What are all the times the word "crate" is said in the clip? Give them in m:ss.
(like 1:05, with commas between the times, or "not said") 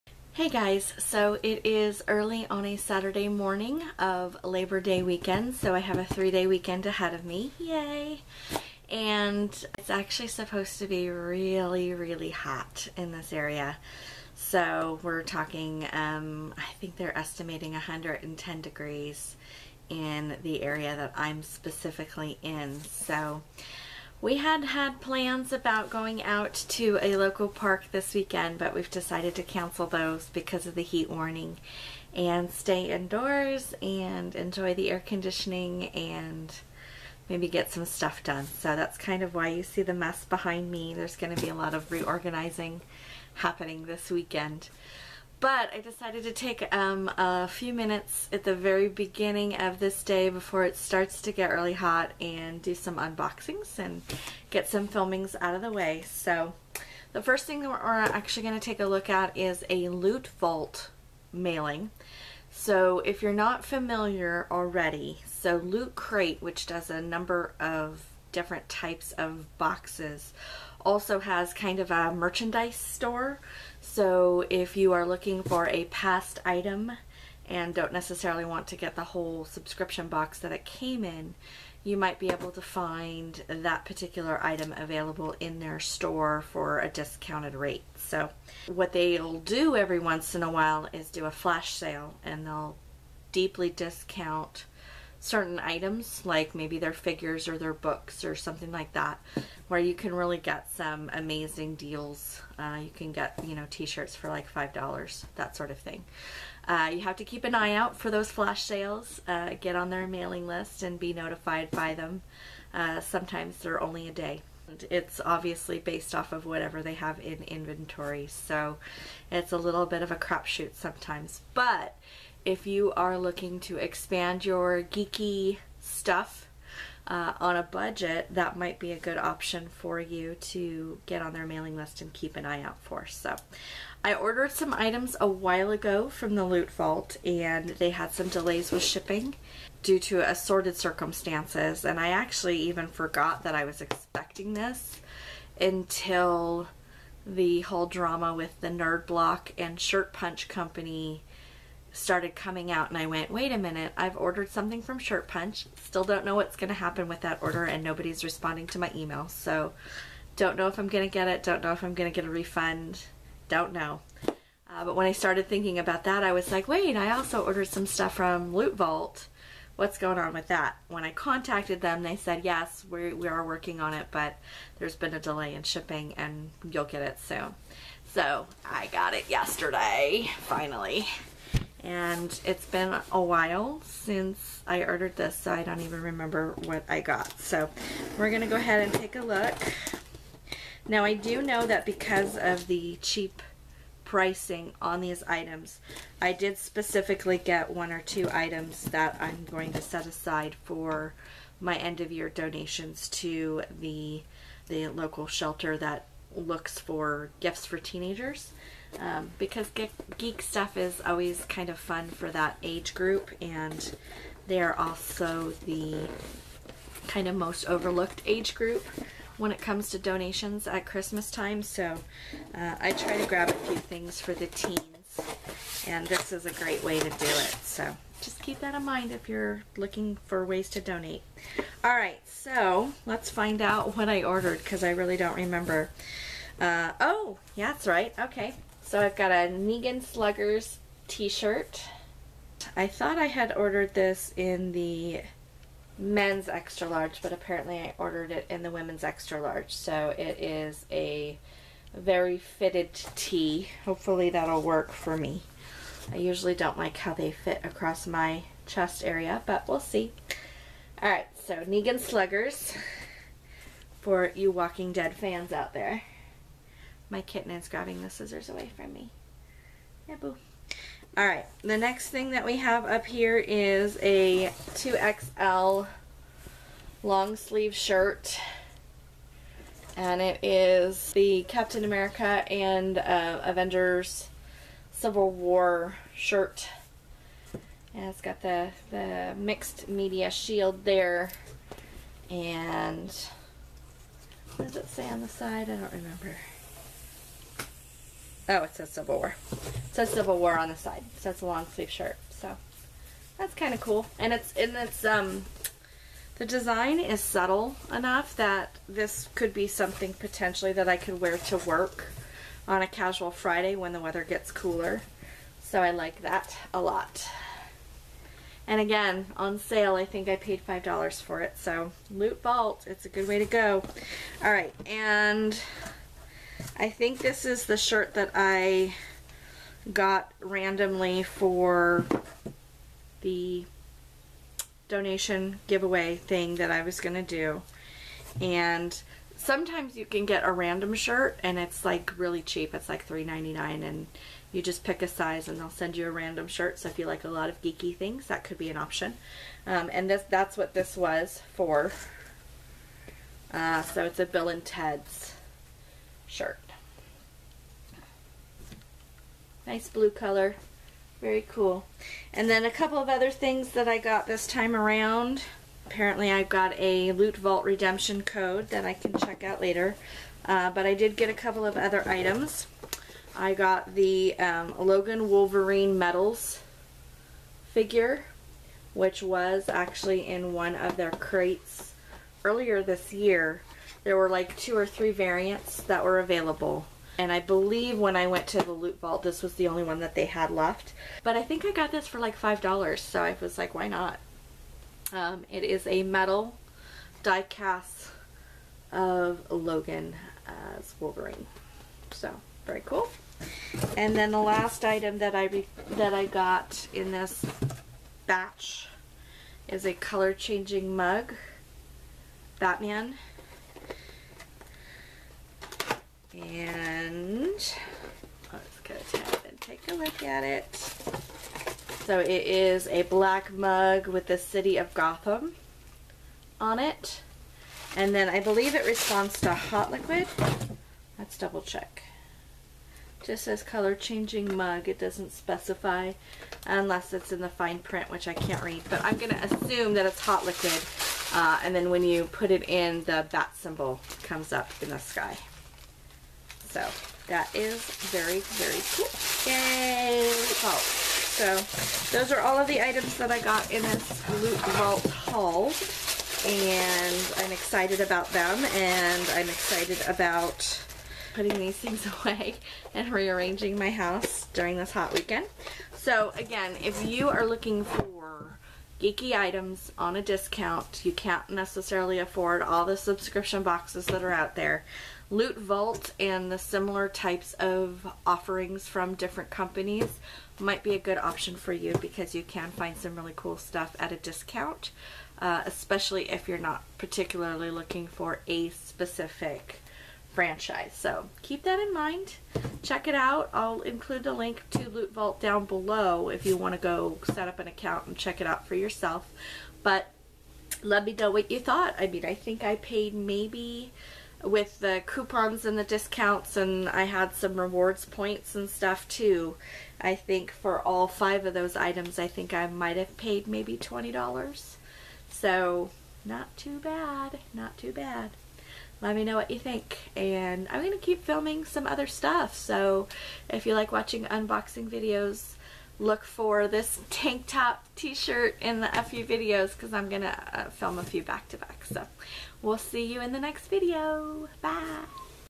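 1:05, 6:21.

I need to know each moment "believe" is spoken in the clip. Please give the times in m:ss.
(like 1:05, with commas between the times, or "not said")
6:27, 7:08.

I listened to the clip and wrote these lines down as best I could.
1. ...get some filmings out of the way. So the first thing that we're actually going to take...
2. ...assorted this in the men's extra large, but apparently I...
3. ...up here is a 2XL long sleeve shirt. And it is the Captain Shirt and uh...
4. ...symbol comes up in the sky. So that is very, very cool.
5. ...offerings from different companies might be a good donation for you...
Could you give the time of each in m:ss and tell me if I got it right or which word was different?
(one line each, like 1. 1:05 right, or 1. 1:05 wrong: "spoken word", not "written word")
1. 0:54 right
2. 4:03 wrong: "ordered", not "assorted"
3. 4:32 wrong: "America", not "Shirt"
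4. 7:23 right
5. 7:58 wrong: "option", not "donation".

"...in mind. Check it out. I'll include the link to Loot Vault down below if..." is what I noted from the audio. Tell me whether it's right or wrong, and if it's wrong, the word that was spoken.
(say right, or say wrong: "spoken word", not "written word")
right.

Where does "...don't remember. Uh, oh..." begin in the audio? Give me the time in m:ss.
3:55.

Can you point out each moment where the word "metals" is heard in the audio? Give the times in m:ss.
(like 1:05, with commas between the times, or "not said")
6:15, 6:36.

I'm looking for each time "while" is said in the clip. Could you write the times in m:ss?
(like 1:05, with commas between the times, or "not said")
1:30, 2:15, 3:03.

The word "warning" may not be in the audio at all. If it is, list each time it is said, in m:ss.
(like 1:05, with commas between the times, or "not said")
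0:31.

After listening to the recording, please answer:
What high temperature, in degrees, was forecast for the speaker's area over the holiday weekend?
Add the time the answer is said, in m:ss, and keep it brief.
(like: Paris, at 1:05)
110, at 0:17.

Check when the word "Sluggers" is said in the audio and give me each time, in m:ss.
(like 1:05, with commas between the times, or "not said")
4:00, 4:21.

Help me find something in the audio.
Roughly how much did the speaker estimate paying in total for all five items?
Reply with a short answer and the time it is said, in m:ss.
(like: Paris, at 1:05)
$20, at 8:33.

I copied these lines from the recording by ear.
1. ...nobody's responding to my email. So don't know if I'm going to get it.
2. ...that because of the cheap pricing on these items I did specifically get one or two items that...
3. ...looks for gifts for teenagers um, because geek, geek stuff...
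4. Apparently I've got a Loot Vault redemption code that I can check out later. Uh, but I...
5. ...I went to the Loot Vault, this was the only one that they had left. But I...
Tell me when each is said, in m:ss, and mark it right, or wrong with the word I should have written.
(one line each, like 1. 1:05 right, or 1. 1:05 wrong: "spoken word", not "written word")
1. 2:37 right
2. 3:11 right
3. 3:26 right
4. 6:05 right
5. 6:28 right.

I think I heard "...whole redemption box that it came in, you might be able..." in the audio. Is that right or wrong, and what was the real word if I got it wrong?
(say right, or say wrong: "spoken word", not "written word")
wrong: "subscription", not "redemption".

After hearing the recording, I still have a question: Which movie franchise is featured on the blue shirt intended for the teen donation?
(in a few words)
Bill and Ted's.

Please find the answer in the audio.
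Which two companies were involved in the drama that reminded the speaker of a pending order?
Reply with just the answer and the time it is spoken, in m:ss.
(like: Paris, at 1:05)
Nerd Block and Shirt Punch, at 2:28.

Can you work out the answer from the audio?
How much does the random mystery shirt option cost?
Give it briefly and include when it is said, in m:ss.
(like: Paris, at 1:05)
$3.99, at 5:43.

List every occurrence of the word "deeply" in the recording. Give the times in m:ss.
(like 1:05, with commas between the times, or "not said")
1:33.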